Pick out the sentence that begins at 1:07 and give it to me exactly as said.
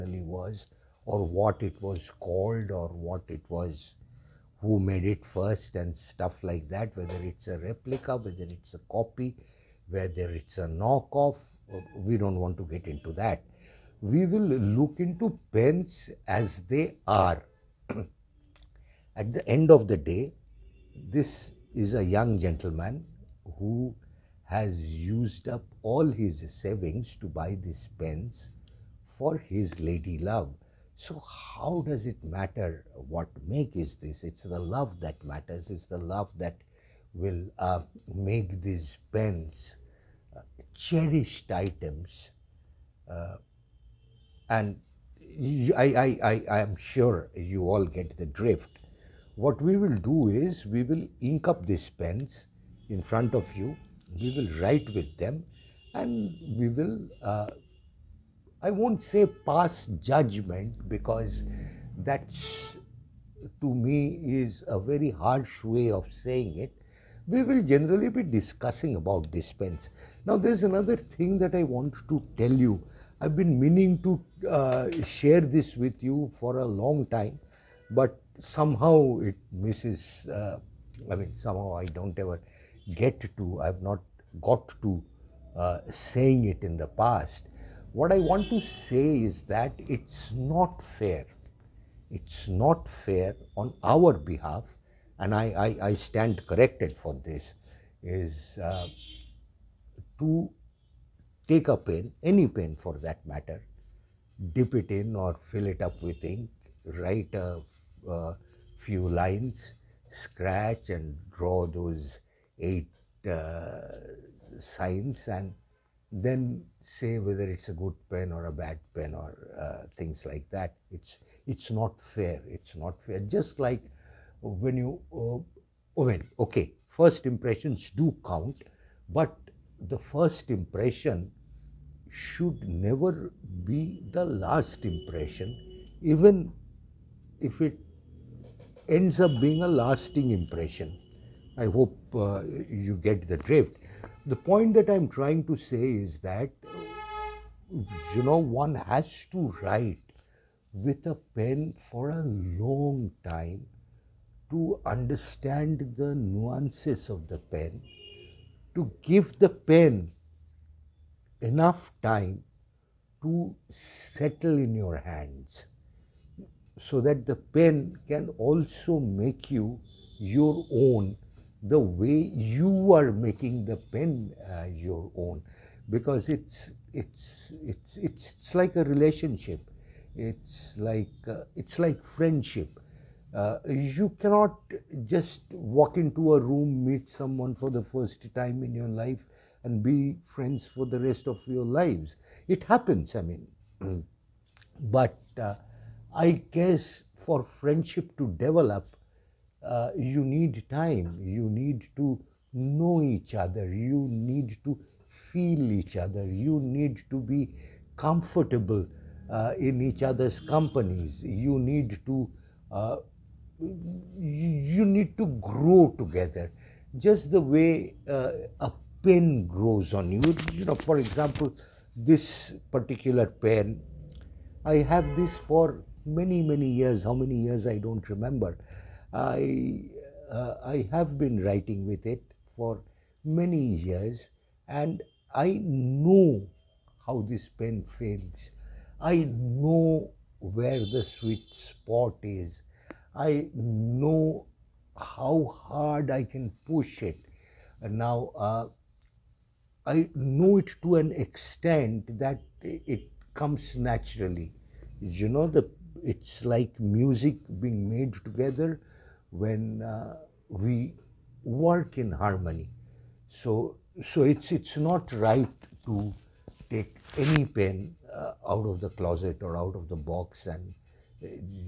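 We will generally be discussing about dispense.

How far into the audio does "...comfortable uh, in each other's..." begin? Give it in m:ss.
3:27.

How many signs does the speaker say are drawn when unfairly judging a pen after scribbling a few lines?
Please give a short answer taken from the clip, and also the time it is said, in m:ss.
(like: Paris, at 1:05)
8, at 1:52.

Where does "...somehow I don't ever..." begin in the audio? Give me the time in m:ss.
1:21.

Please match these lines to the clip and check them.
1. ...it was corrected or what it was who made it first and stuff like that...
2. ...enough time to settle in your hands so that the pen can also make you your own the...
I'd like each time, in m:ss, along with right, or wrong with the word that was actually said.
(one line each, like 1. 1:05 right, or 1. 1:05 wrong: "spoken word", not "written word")
1. 0:01 wrong: "called", not "corrected"
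2. 2:41 right.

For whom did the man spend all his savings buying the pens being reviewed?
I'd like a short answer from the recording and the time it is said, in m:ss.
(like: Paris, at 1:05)
his lady love, at 0:29.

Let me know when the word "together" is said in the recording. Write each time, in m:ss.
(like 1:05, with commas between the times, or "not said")
3:35, 4:18.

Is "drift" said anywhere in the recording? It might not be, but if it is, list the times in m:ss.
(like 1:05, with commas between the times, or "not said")
0:48, 2:23.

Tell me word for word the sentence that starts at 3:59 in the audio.
I know where the sweet spot is.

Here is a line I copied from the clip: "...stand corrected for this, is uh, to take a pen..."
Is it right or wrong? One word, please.
right.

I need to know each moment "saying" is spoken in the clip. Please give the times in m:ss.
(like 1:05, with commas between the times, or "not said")
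1:06, 1:25.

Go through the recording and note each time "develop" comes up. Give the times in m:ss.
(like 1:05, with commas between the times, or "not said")
3:18.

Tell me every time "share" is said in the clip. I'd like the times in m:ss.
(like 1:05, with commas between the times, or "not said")
1:15.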